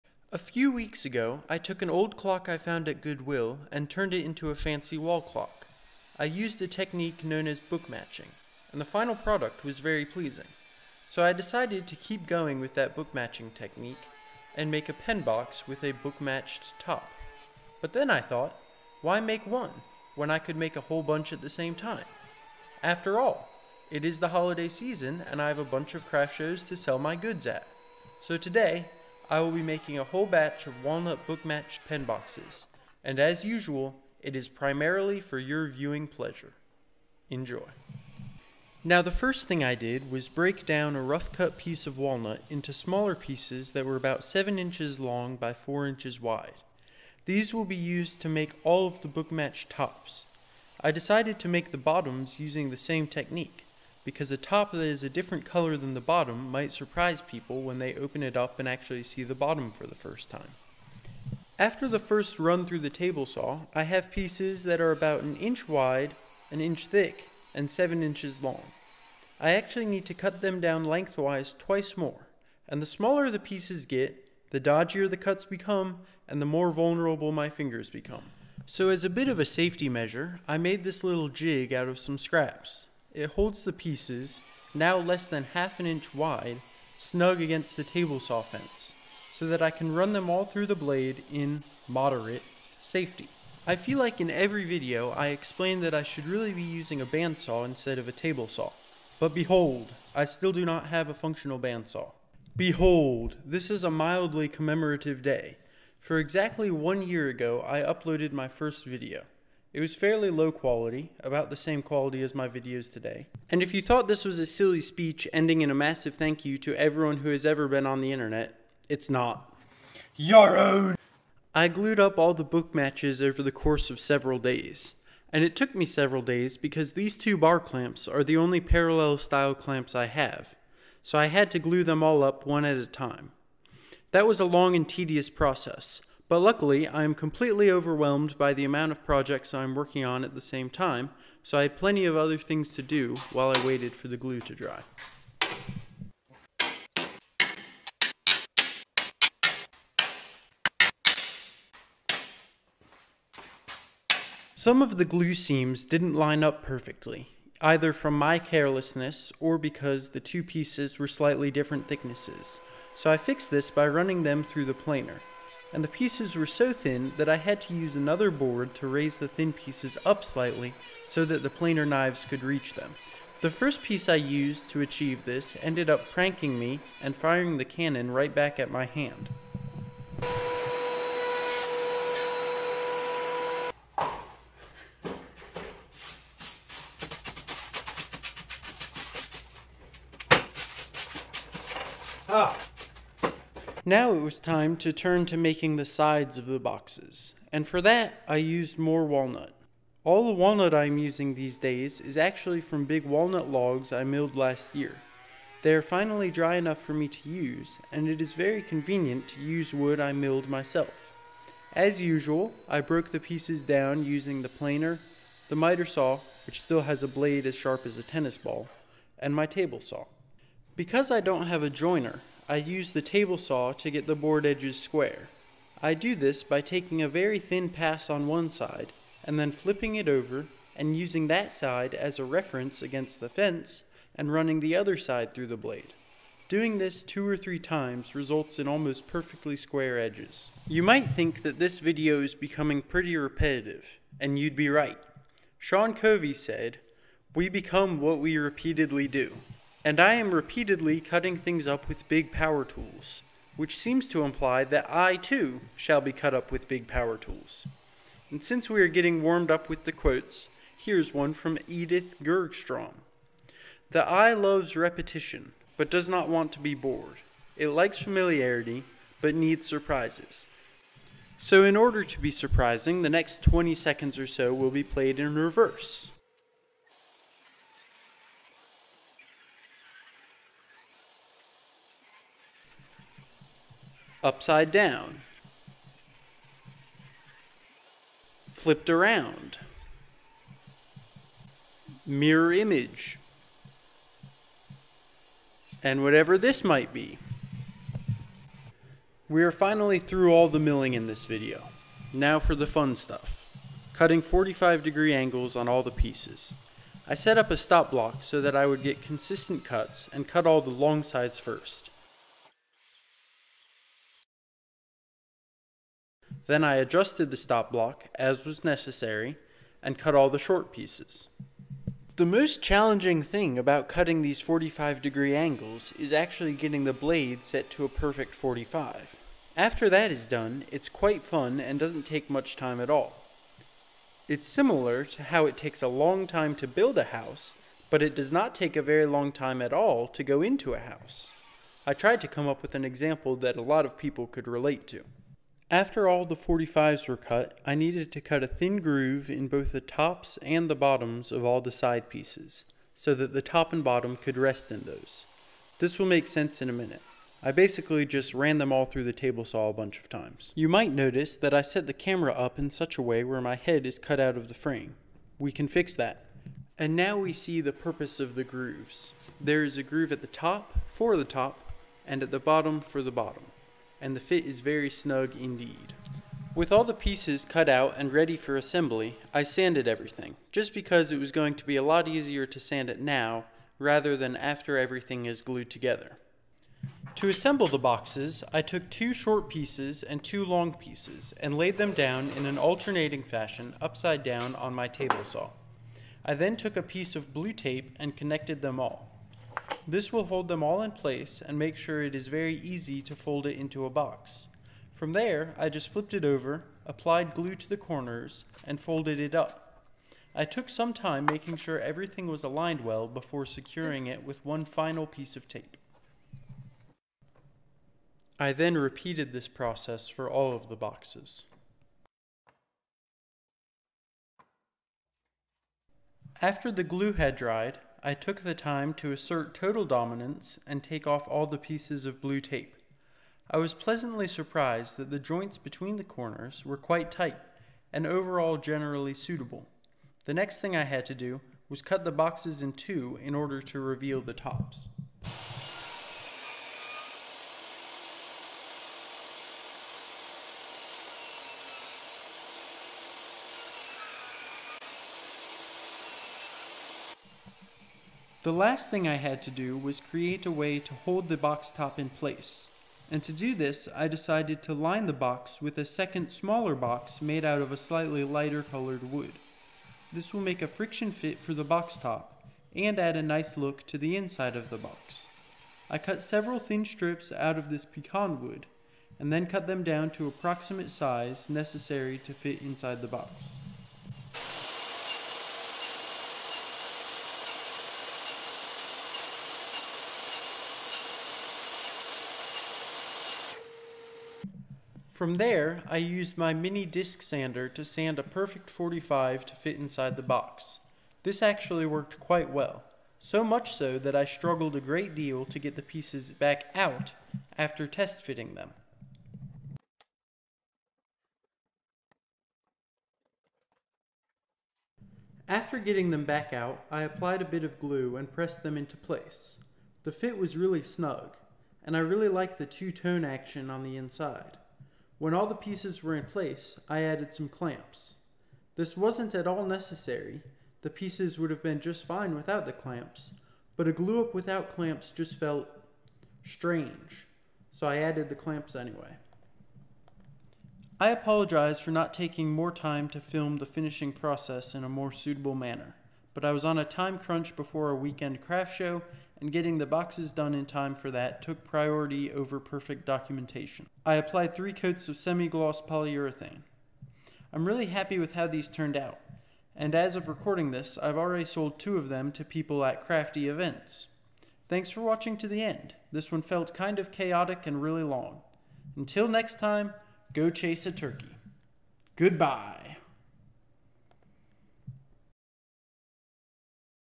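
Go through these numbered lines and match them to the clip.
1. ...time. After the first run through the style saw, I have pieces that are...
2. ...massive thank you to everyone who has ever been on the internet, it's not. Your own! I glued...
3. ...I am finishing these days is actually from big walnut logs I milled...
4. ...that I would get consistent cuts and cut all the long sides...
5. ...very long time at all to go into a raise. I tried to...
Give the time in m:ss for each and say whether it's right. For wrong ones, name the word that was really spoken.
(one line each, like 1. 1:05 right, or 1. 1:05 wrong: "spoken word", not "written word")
1. 1:00 wrong: "table", not "style"
2. 1:55 right
3. 3:20 wrong: "using", not "finishing"
4. 5:08 right
5. 5:38 wrong: "house", not "raise".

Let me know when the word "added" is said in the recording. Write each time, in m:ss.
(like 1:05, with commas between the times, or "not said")
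8:47, 8:57.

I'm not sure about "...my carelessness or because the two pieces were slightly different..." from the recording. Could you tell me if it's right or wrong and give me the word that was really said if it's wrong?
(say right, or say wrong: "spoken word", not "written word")
right.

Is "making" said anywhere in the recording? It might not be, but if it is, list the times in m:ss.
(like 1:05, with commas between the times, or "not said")
0:29, 3:15, 6:51.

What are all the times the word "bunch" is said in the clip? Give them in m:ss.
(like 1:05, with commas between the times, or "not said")
0:21, 0:25, 5:59.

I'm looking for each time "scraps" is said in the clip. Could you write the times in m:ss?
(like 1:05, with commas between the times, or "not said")
1:22.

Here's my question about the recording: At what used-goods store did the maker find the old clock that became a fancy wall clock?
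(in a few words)
Goodwill.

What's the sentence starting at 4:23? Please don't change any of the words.
The eye loves repetition, but does not want to be bored.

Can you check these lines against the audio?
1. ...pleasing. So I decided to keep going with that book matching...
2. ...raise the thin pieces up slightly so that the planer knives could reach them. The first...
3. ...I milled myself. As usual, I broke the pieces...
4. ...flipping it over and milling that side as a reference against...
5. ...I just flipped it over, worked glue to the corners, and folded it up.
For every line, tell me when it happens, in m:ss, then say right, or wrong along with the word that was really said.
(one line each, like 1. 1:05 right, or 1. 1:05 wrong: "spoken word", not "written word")
1. 0:10 right
2. 2:48 right
3. 3:29 right
4. 3:49 wrong: "using", not "milling"
5. 6:45 wrong: "applied", not "worked".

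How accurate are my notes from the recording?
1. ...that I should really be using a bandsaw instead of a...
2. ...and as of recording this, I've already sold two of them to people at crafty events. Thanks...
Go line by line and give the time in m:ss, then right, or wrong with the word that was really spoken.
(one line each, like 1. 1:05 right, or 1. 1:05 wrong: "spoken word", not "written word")
1. 1:35 right
2. 9:19 right.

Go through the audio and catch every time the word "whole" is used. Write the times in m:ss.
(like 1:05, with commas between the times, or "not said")
0:20, 0:30.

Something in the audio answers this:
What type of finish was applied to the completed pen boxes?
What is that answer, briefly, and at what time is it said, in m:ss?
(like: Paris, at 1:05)
semi-gloss polyurethane, at 9:15.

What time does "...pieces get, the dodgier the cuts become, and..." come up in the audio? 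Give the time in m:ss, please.
1:13.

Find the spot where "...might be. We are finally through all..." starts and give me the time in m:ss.
4:56.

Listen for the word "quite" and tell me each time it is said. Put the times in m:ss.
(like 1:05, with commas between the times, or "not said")
5:30, 7:16, 8:22.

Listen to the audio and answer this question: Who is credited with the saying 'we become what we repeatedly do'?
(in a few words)
Sean Covey.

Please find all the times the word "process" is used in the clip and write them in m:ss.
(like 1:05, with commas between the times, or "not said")
2:15, 6:59, 9:04.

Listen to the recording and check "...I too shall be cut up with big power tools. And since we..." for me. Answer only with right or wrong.
right.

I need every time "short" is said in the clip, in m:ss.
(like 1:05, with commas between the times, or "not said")
5:20, 6:29.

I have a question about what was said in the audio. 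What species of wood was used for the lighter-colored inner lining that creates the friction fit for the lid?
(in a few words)
pecan.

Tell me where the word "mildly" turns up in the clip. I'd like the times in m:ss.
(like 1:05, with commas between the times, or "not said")
1:43.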